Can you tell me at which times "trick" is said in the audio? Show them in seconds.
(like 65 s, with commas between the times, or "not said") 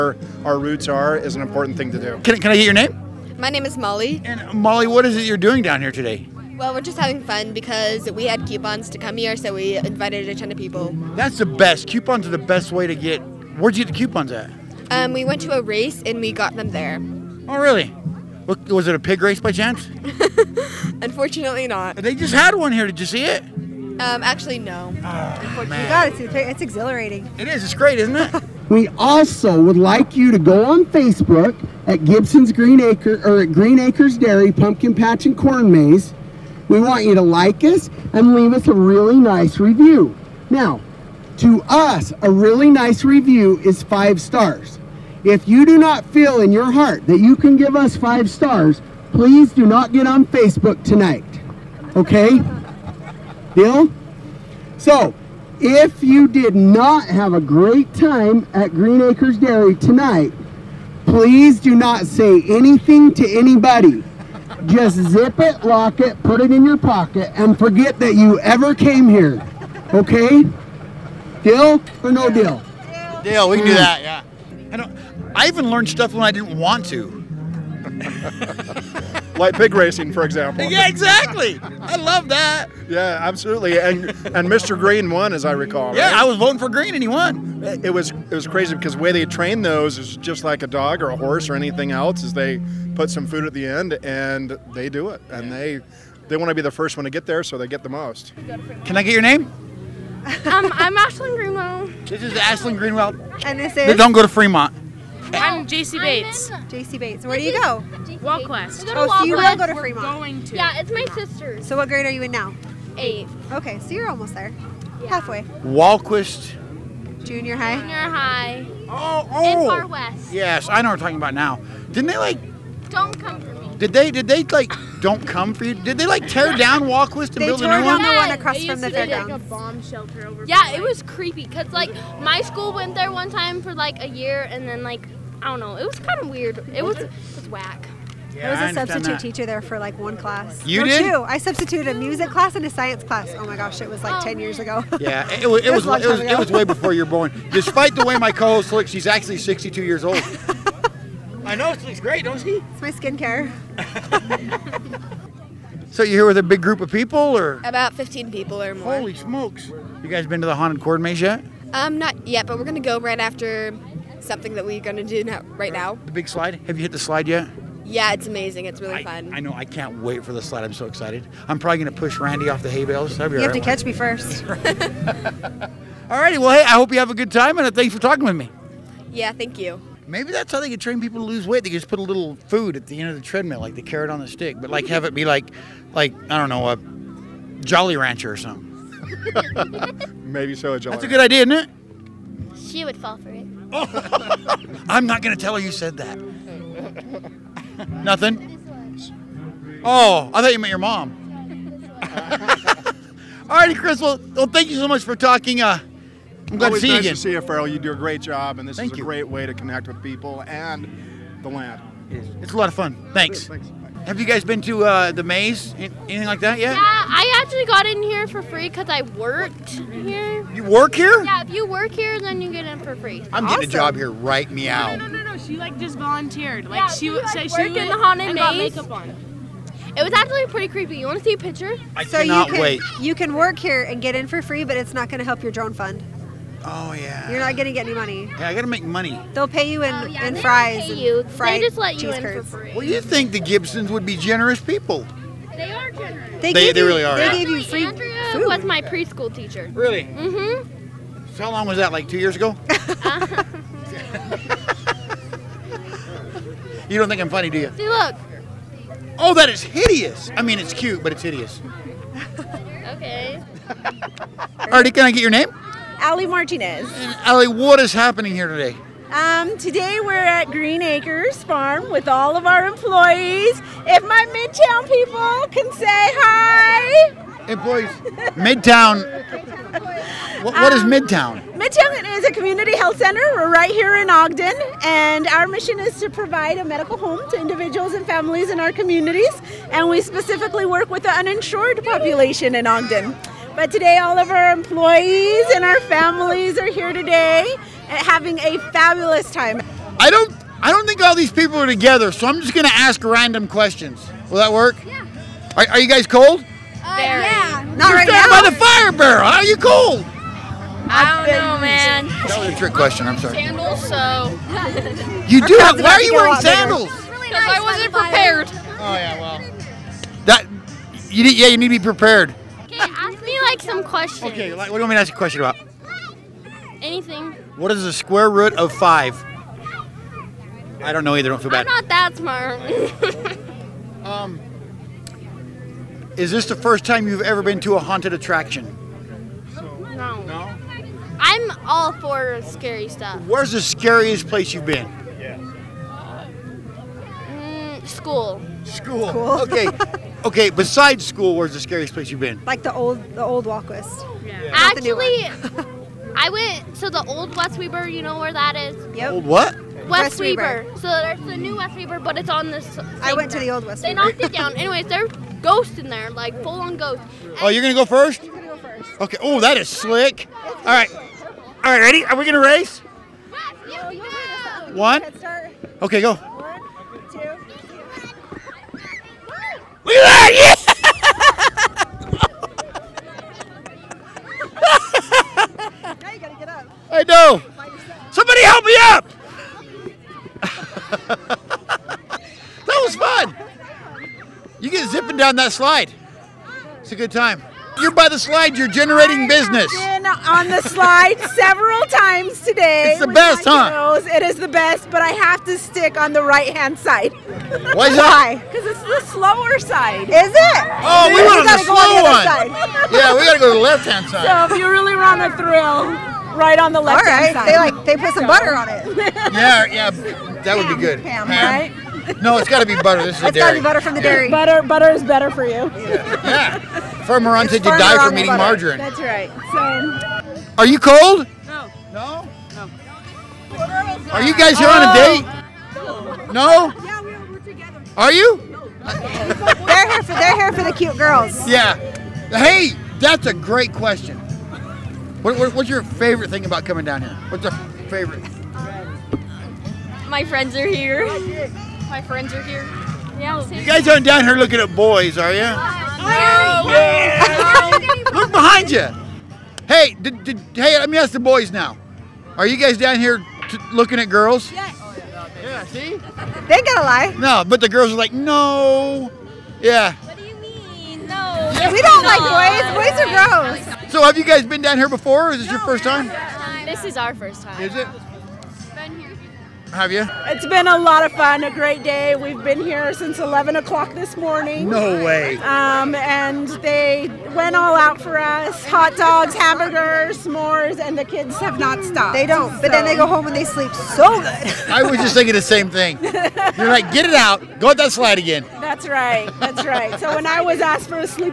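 312 s.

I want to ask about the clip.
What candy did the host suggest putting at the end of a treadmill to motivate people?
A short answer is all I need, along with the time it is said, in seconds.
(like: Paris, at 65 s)
A Jolly Rancher, at 186 s.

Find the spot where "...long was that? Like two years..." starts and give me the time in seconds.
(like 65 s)
251 s.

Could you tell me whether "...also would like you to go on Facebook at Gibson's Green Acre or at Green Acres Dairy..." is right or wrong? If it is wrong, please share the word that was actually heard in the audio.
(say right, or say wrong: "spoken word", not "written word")
right.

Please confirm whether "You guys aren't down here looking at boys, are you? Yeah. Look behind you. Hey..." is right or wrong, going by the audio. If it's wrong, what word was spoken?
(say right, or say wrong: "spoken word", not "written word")
right.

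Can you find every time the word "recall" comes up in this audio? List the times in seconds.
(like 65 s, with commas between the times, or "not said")
85 s.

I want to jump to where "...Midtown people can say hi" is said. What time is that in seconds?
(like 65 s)
274 s.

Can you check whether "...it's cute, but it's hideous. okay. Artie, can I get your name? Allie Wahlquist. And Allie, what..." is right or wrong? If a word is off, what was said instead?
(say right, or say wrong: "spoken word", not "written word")
wrong: "Martinez", not "Wahlquist".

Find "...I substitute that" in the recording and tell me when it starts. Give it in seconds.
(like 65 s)
138 s.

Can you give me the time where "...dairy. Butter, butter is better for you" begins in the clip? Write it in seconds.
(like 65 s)
424 s.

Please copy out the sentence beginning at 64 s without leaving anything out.
Just zip it, lock it, put it in your pocket, and forget that you ever came here.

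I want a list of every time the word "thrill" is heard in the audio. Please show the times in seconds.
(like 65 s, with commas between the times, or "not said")
415 s.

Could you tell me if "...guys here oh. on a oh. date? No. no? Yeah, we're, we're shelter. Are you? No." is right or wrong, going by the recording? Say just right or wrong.
wrong.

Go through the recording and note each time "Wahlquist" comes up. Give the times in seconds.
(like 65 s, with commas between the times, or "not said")
115 s, 126 s, 353 s.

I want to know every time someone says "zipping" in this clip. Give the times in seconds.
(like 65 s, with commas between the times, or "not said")
394 s.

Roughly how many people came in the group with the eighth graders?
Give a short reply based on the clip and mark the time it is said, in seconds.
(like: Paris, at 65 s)
About 15, at 157 s.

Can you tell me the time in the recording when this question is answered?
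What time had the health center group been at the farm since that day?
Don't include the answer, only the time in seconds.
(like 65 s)
483 s.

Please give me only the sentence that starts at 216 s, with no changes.
Yeah, I actually got in here for free because I worked here.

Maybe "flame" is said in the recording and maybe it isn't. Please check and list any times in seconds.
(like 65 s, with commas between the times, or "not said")
not said.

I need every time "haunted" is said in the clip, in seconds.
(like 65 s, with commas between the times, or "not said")
160 s, 227 s, 337 s.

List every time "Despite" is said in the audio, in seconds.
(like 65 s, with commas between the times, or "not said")
147 s.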